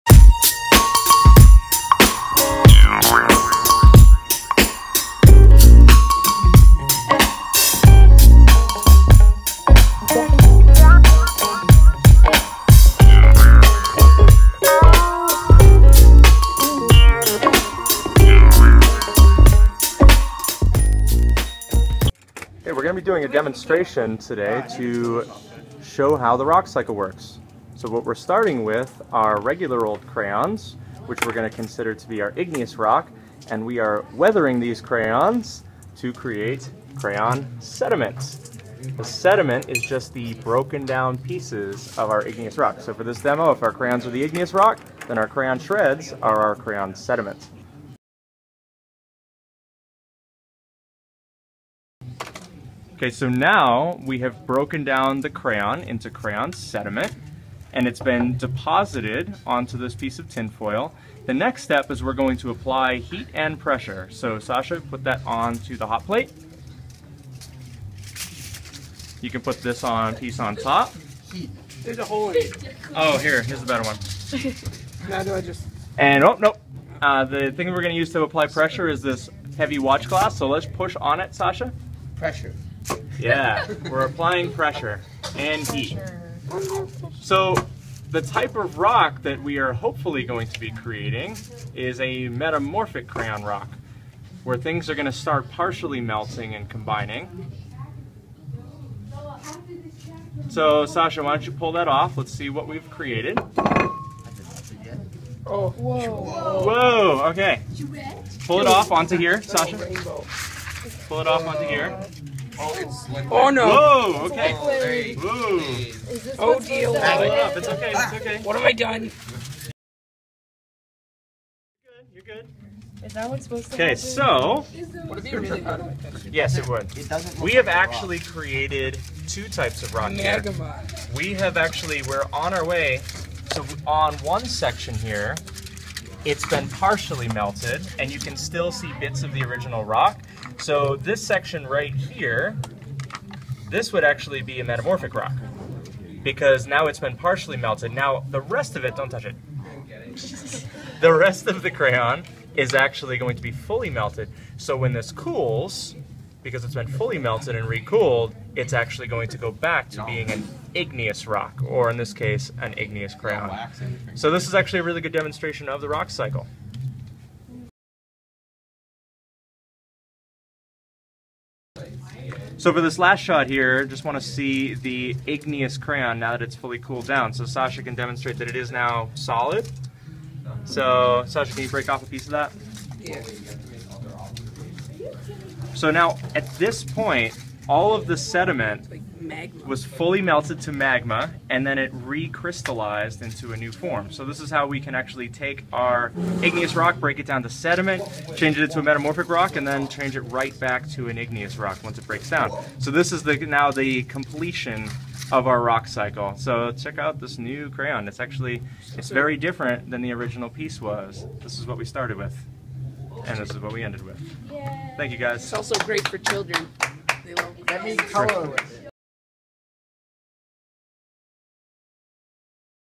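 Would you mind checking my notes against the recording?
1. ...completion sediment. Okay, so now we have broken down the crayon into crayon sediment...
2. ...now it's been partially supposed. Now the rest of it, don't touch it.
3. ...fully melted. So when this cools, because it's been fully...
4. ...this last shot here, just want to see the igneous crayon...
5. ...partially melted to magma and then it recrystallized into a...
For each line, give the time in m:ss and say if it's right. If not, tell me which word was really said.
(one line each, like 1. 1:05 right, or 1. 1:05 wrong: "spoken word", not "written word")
1. 0:46 wrong: "crayon", not "completion"
2. 2:26 wrong: "melted", not "supposed"
3. 2:33 right
4. 2:52 right
5. 3:09 wrong: "fully", not "partially".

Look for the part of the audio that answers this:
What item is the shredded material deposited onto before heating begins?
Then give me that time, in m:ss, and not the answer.
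1:00.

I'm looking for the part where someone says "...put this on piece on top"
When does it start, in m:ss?
1:09.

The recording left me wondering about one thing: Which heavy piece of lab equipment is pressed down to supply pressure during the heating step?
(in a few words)
watch glass.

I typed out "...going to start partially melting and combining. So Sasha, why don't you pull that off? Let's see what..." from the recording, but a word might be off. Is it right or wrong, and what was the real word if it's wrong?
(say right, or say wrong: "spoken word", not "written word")
right.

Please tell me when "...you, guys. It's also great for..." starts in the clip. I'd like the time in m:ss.
3:35.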